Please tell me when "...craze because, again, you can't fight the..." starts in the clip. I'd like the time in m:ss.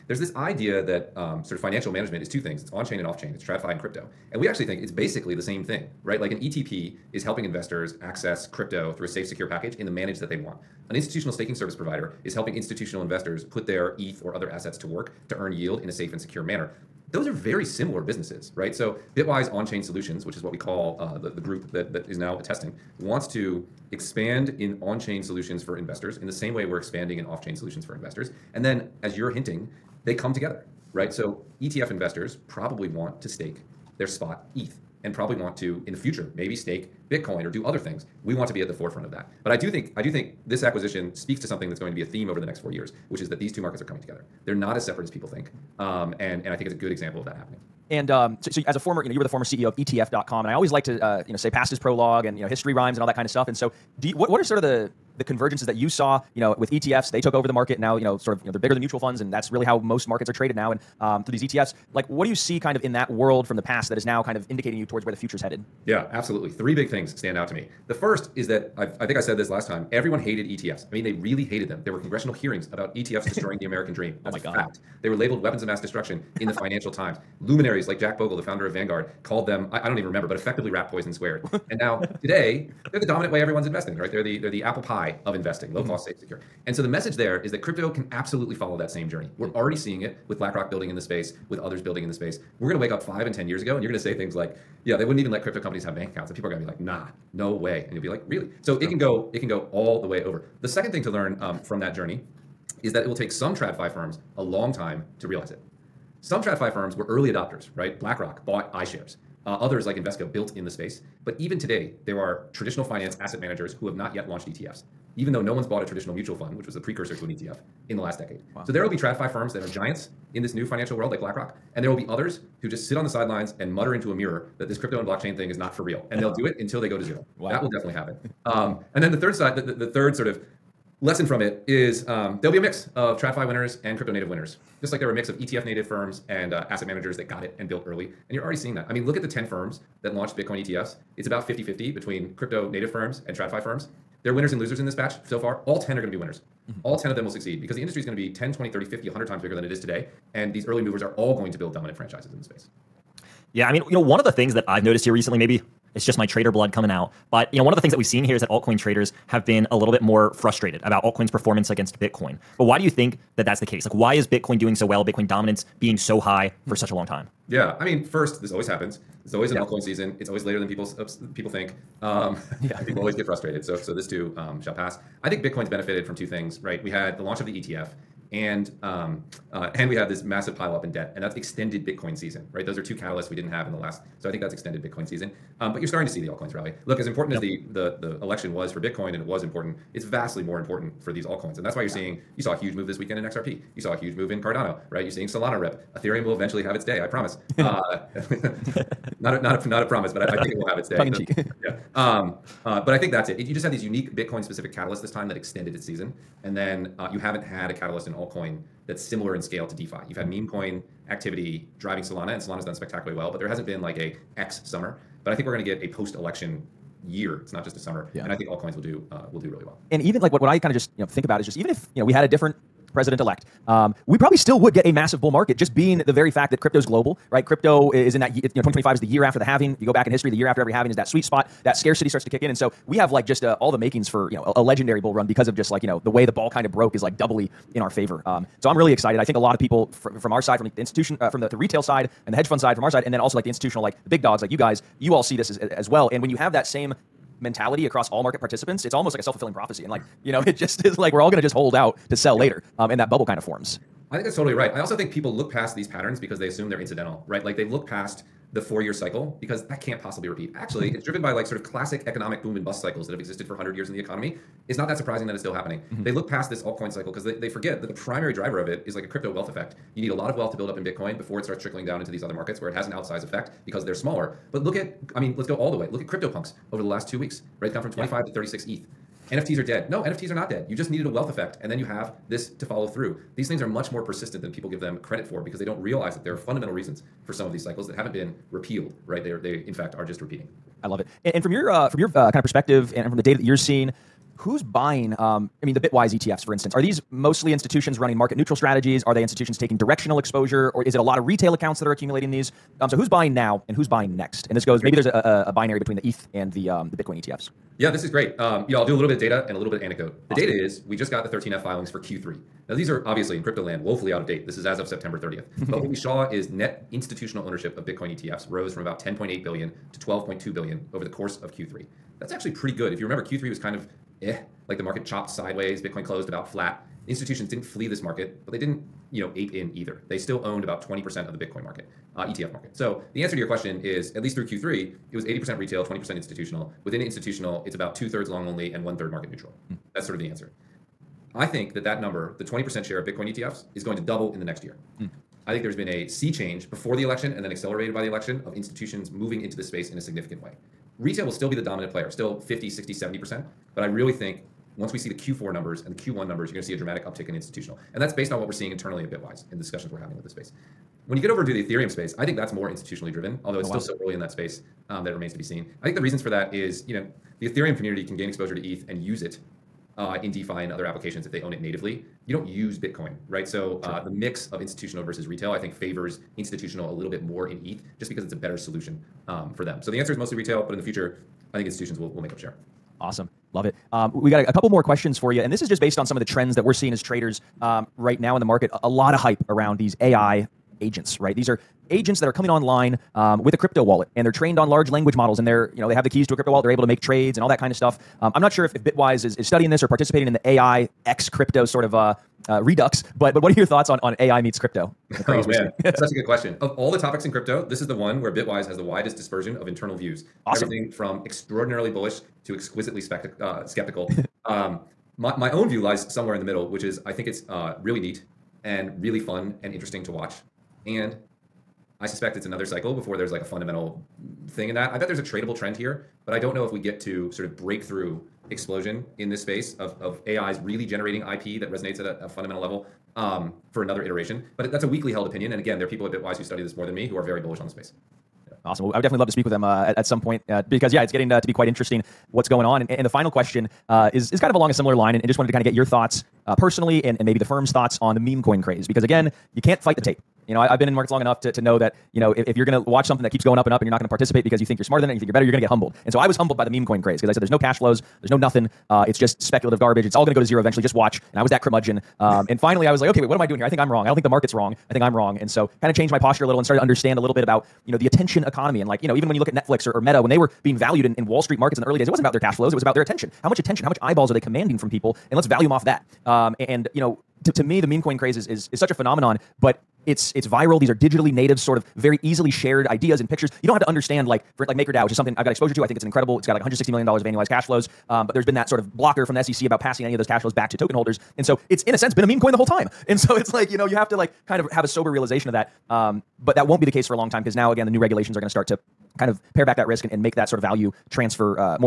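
7:28.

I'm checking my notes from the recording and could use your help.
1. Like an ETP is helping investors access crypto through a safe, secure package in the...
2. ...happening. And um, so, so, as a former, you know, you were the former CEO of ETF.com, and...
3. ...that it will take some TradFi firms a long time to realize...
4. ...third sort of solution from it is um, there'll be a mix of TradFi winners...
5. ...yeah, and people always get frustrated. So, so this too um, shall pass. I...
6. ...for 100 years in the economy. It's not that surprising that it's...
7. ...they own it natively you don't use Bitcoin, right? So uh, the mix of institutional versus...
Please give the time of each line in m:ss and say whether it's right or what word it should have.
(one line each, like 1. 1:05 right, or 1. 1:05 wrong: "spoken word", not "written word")
1. 0:06 right
2. 0:47 right
3. 1:42 right
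4. 2:09 wrong: "lesson", not "solution"
5. 2:52 right
6. 4:23 right
7. 6:11 right.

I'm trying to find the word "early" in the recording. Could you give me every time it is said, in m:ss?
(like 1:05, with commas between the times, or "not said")
1:47, 2:17, 2:30, 6:04, 7:51.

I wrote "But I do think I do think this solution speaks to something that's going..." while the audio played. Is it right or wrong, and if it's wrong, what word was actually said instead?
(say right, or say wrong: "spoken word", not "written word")
wrong: "acquisition", not "solution".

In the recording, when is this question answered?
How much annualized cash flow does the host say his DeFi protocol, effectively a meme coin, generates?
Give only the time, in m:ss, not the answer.
8:06.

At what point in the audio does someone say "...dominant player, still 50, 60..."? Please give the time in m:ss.
5:51.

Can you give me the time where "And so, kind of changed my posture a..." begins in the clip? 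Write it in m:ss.
7:45.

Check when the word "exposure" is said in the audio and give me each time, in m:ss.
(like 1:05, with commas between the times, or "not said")
5:00, 6:08, 8:05.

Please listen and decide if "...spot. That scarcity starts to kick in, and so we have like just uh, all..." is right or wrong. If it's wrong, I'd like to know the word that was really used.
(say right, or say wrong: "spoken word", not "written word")
right.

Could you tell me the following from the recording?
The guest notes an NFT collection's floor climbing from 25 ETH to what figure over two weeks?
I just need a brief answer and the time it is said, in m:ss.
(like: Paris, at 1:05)
36 ETH, at 4:38.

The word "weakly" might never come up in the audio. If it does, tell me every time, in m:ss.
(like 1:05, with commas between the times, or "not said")
7:14.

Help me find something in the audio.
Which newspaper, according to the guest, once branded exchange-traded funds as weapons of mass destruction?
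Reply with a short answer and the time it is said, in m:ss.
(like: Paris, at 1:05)
Financial Times, at 1:16.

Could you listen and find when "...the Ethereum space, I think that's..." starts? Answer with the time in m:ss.
6:01.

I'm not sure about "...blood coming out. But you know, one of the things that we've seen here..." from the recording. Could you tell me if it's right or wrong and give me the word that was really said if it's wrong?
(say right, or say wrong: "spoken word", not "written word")
right.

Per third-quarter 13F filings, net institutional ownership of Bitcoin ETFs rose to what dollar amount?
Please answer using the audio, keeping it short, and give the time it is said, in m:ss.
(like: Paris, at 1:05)
$12.2 billion, at 5:19.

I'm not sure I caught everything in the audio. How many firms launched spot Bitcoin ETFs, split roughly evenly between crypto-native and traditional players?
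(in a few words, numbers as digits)
10.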